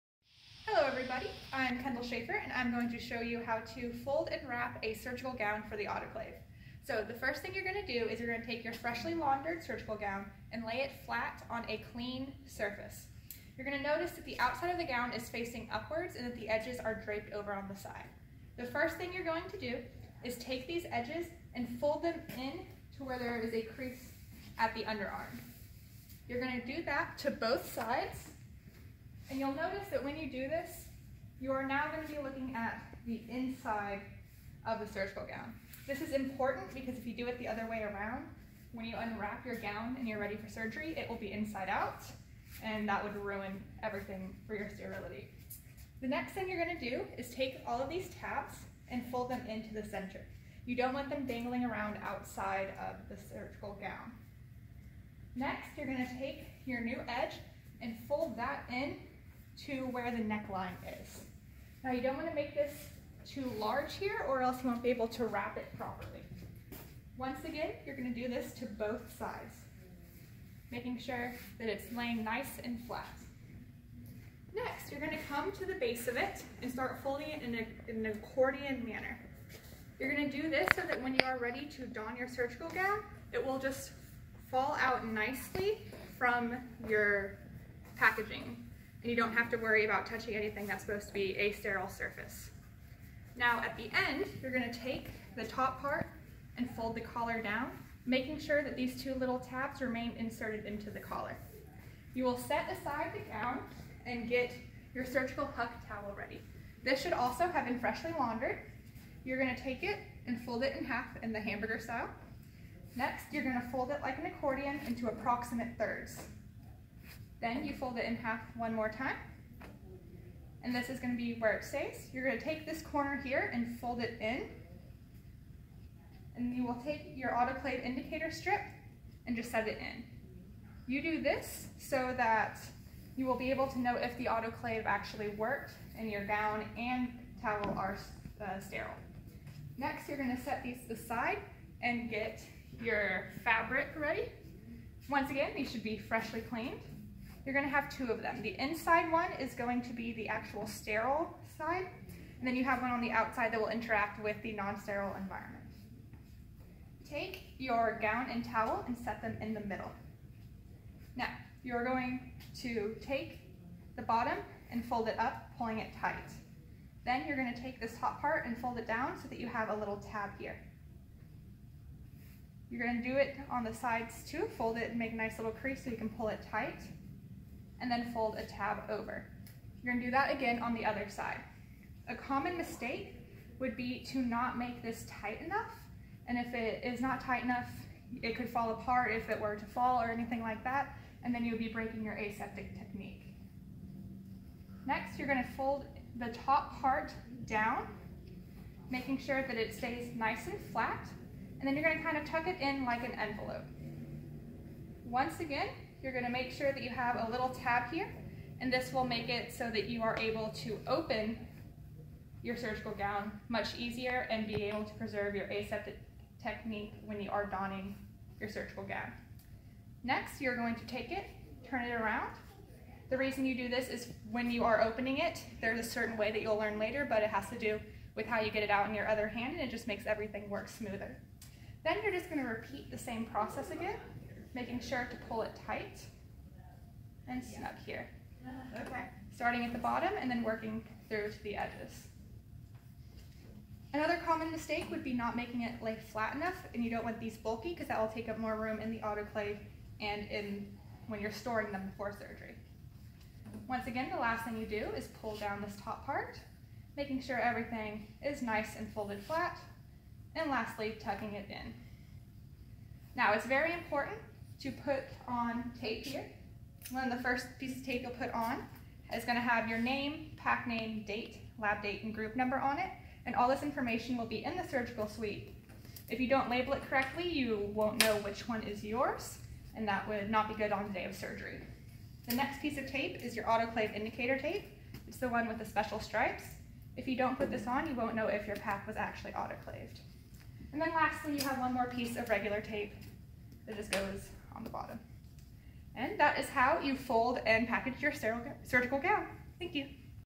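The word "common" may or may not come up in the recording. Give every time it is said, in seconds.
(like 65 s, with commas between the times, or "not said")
182 s, 244 s.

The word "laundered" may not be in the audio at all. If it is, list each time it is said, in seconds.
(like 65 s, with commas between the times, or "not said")
9 s, 108 s.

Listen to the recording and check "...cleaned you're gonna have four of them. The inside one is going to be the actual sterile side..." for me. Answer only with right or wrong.
wrong.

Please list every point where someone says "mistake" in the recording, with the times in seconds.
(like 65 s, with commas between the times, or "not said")
182 s, 244 s.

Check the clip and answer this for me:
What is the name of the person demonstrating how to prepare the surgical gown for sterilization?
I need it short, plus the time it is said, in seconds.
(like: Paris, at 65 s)
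Kendall Schaefer, at 1 s.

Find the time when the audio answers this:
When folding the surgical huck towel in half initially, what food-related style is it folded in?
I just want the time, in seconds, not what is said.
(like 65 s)
111 s.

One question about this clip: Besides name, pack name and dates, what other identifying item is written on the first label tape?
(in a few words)
group number.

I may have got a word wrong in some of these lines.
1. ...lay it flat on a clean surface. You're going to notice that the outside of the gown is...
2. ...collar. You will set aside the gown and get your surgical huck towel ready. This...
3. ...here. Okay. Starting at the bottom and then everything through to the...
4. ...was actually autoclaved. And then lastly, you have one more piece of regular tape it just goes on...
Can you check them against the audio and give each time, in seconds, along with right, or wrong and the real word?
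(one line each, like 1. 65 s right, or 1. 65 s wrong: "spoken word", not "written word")
1. 10 s right
2. 100 s right
3. 237 s wrong: "working", not "everything"
4. 288 s right.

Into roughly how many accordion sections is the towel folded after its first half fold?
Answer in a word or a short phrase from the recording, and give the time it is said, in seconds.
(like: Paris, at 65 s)
thirds, at 115 s.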